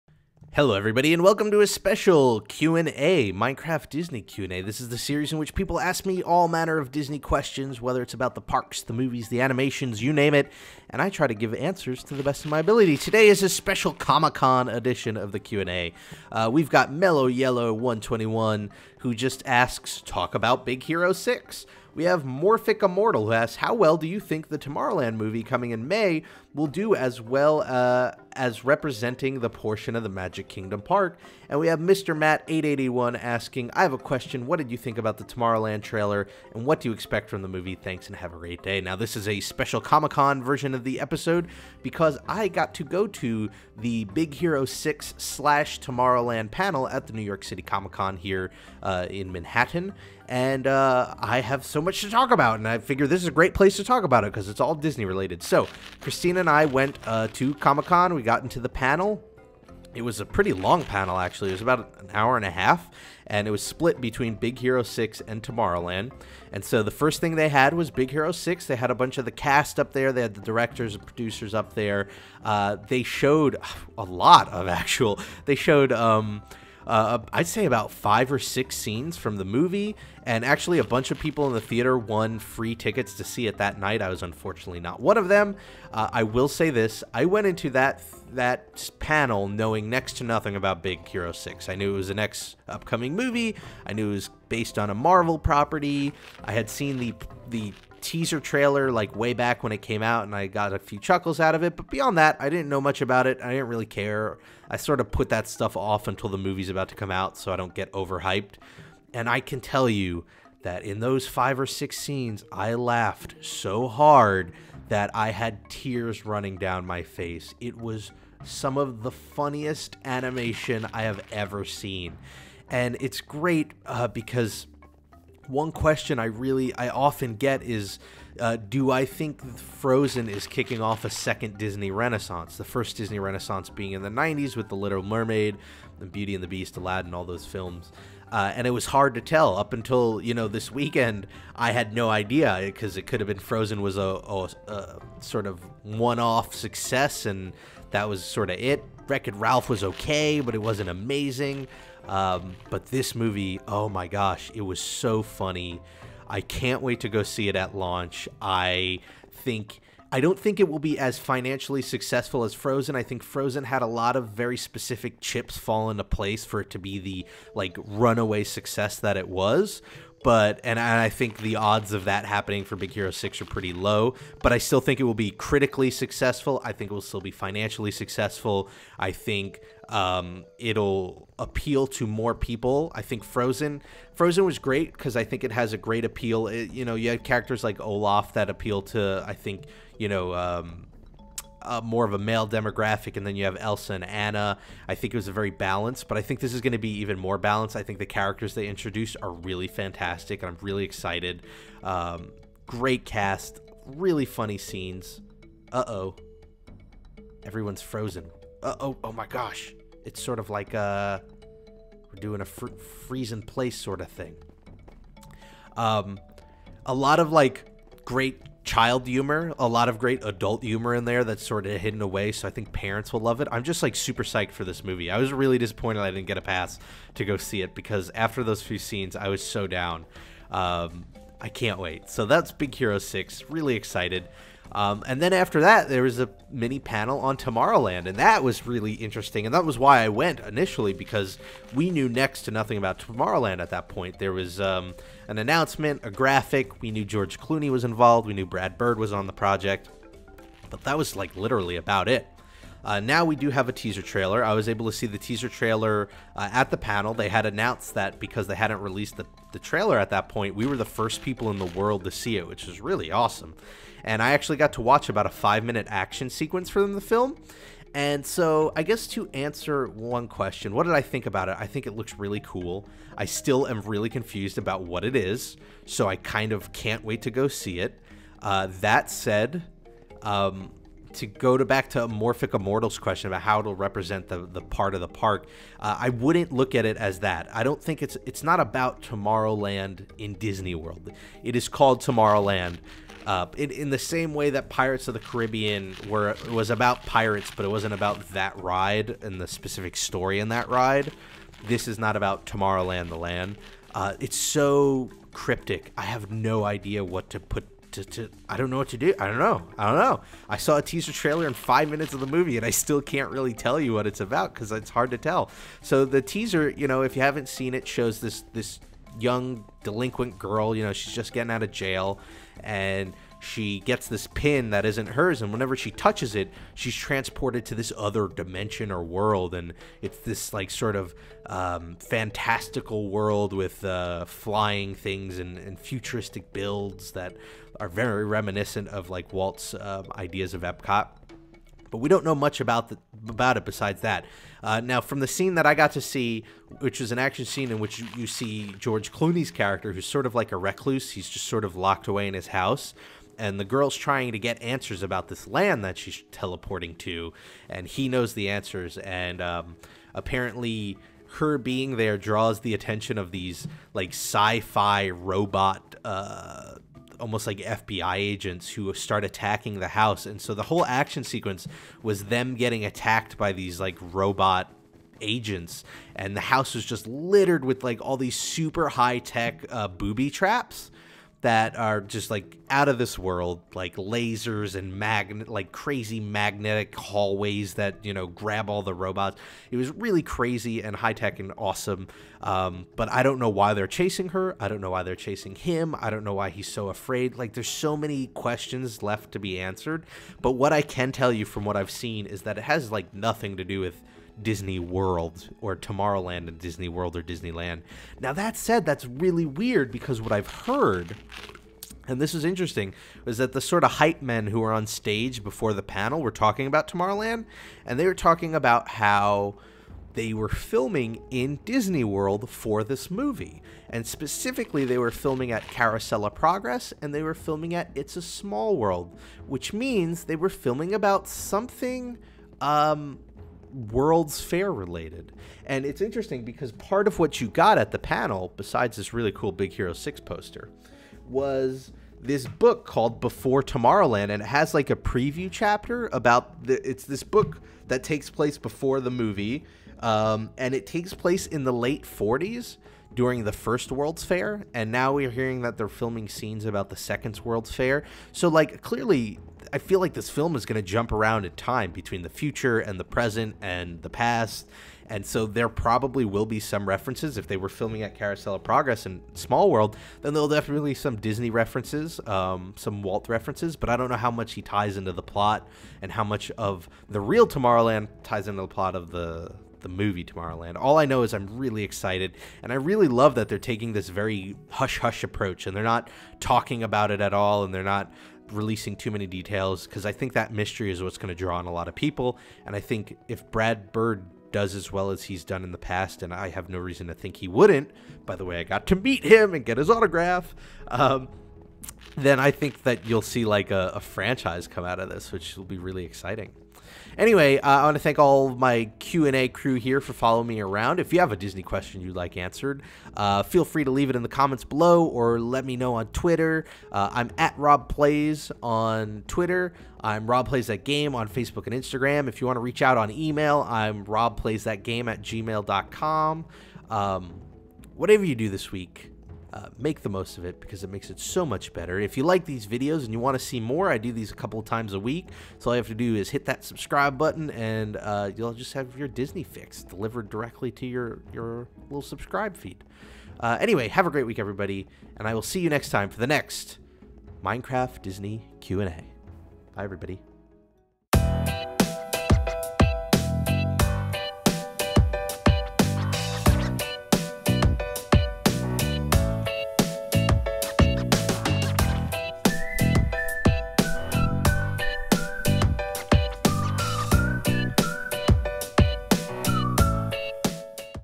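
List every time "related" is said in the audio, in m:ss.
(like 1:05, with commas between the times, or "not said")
0:55, 7:14.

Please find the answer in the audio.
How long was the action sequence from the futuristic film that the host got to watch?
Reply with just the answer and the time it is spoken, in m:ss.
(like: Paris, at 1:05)
5 minutes, at 4:25.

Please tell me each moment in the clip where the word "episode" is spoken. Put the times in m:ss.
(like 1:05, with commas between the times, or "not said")
0:40.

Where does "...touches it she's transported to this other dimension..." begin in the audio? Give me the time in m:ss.
5:25.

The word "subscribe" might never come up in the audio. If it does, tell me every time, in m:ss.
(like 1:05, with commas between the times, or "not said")
8:56, 9:02.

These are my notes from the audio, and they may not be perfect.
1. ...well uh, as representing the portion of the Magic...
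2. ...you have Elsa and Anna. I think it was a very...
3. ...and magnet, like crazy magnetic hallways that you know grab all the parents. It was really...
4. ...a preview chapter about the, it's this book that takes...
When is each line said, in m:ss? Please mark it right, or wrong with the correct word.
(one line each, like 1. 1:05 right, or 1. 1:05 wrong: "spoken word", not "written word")
1. 0:27 right
2. 3:13 right
3. 6:24 wrong: "robots", not "parents"
4. 7:24 right.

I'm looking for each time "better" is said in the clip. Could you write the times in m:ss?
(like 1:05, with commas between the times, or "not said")
8:51.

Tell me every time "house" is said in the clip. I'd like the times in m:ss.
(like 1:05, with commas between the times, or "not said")
5:52, 6:09, 6:16.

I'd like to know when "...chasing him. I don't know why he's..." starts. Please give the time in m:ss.
6:35.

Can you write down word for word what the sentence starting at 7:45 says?
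And so there probably will be some references.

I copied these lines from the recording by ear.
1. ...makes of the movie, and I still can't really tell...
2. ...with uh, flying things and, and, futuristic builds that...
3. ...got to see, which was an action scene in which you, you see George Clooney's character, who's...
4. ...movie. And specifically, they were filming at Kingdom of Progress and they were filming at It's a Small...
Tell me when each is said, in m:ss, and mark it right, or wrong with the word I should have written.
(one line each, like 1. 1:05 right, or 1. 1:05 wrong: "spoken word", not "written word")
1. 5:11 wrong: "minutes", not "makes"
2. 5:33 right
3. 5:45 right
4. 7:03 wrong: "Carousel", not "Kingdom".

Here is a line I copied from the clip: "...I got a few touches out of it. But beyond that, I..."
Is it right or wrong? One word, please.
wrong.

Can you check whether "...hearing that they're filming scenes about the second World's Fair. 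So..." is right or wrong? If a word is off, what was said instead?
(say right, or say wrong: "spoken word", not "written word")
right.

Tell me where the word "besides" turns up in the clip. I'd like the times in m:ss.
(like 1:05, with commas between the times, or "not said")
5:43, 7:18.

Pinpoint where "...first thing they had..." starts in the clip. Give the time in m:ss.
1:06.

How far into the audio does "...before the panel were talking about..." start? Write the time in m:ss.
6:55.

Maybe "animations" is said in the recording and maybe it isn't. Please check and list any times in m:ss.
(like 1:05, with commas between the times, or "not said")
0:09, 2:00.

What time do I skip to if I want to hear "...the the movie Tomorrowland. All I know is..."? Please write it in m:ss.
7:59.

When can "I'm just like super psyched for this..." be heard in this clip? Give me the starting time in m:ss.
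3:43.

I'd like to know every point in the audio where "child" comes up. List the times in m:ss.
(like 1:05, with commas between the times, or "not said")
3:38.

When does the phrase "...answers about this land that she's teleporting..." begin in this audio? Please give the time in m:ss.
5:54.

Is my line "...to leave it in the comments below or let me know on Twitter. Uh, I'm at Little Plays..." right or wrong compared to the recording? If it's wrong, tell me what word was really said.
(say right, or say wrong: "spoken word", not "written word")
wrong: "Rob", not "Little".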